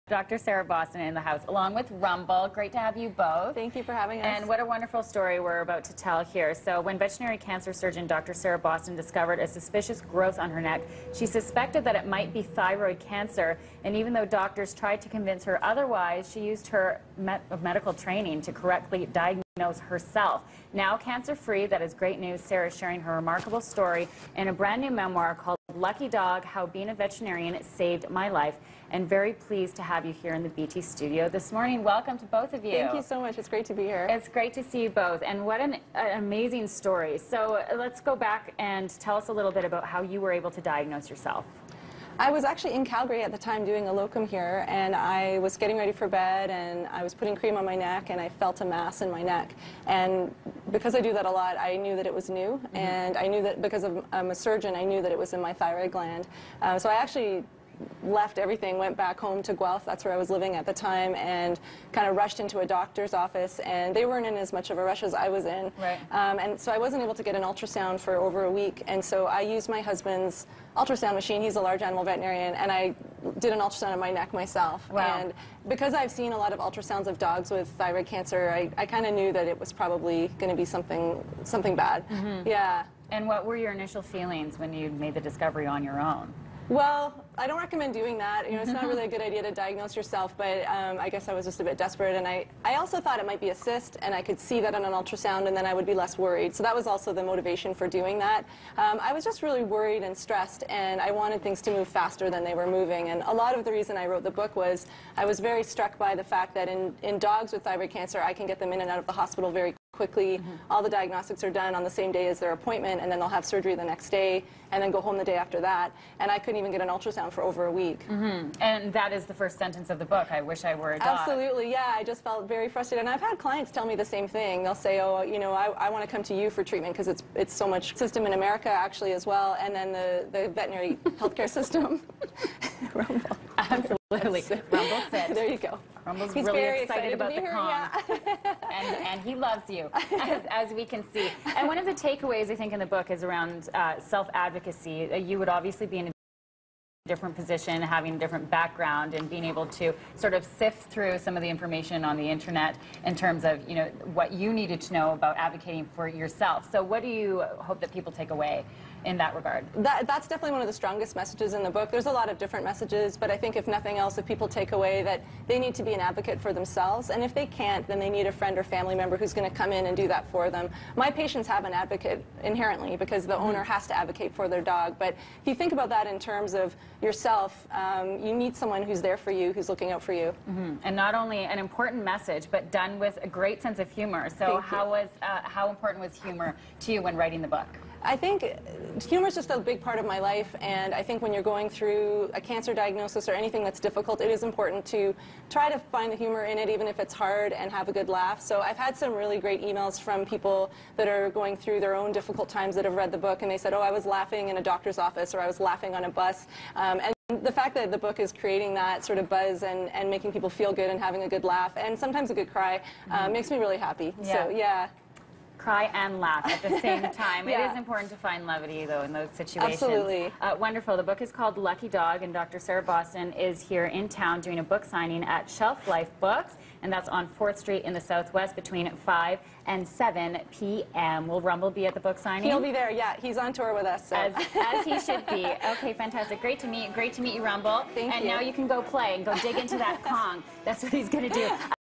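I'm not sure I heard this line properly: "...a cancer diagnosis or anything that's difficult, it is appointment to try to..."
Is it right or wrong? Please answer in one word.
wrong.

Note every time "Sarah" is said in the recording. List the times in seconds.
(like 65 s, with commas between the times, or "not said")
0 s, 8 s, 22 s, 222 s.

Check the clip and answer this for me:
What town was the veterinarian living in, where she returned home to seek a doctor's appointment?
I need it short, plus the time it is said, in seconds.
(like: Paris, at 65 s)
Guelph, at 59 s.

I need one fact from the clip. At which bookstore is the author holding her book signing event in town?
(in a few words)
Shelf Life Books.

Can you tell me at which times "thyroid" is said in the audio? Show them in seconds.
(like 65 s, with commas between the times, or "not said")
12 s, 55 s, 77 s, 107 s.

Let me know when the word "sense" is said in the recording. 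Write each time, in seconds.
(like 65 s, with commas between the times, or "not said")
183 s.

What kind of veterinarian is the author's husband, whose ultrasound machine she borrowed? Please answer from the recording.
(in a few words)
Large animal veterinarian.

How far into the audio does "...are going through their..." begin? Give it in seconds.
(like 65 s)
201 s.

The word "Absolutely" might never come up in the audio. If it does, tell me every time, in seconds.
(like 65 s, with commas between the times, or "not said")
121 s, 133 s, 219 s.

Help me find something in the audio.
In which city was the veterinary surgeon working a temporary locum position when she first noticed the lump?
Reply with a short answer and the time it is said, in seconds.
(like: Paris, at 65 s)
Calgary, at 42 s.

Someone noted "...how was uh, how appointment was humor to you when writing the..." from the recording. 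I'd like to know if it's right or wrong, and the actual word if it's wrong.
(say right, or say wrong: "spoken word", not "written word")
wrong: "important", not "appointment".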